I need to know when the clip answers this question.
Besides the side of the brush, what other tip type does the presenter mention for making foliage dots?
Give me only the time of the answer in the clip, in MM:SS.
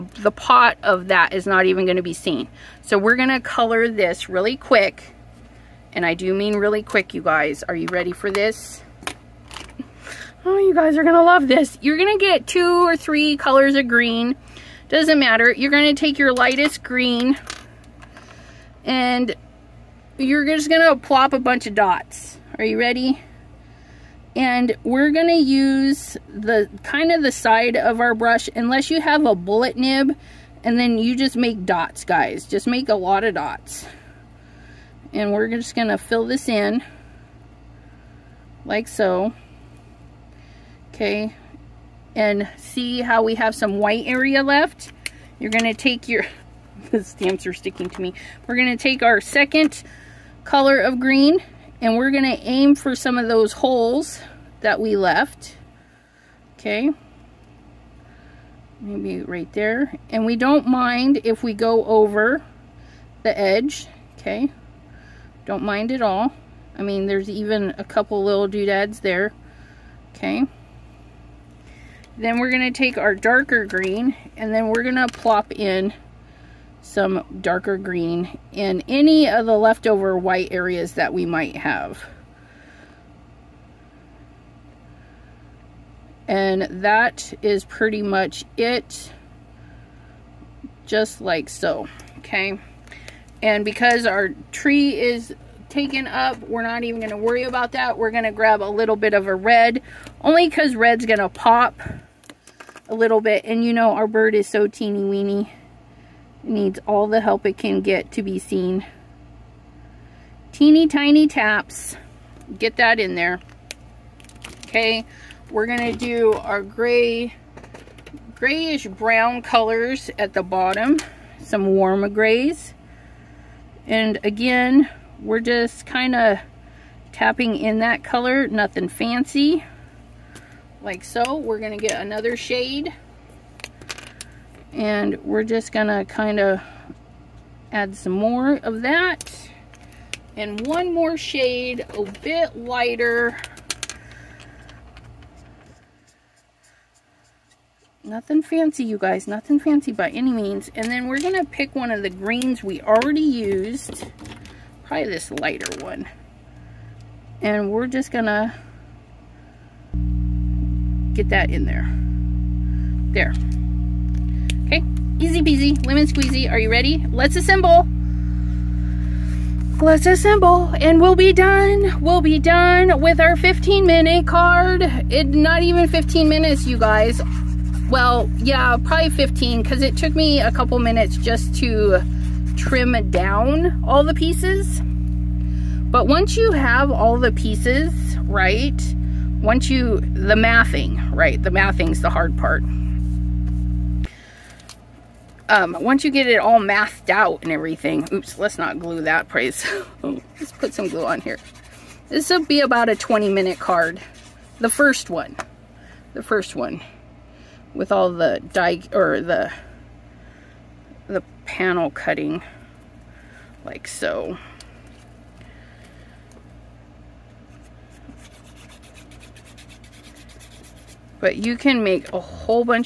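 00:29.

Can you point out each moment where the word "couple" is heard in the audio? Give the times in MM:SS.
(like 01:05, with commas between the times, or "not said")
01:07, 03:00.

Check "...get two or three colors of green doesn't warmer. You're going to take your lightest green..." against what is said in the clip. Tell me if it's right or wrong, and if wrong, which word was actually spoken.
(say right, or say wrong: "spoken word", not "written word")
wrong: "matter", not "warmer".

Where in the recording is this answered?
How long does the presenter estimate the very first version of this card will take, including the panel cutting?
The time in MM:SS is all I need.
03:22.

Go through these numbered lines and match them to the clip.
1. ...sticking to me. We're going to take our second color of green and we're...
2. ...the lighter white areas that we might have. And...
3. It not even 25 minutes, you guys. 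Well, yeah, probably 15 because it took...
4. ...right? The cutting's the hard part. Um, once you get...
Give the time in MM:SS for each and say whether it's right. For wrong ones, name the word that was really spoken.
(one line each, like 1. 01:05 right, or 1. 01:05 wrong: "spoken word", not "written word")
1. 00:47 right
2. 01:19 wrong: "leftover", not "lighter"
3. 02:55 wrong: "15", not "25"
4. 03:11 wrong: "mathing", not "cutting".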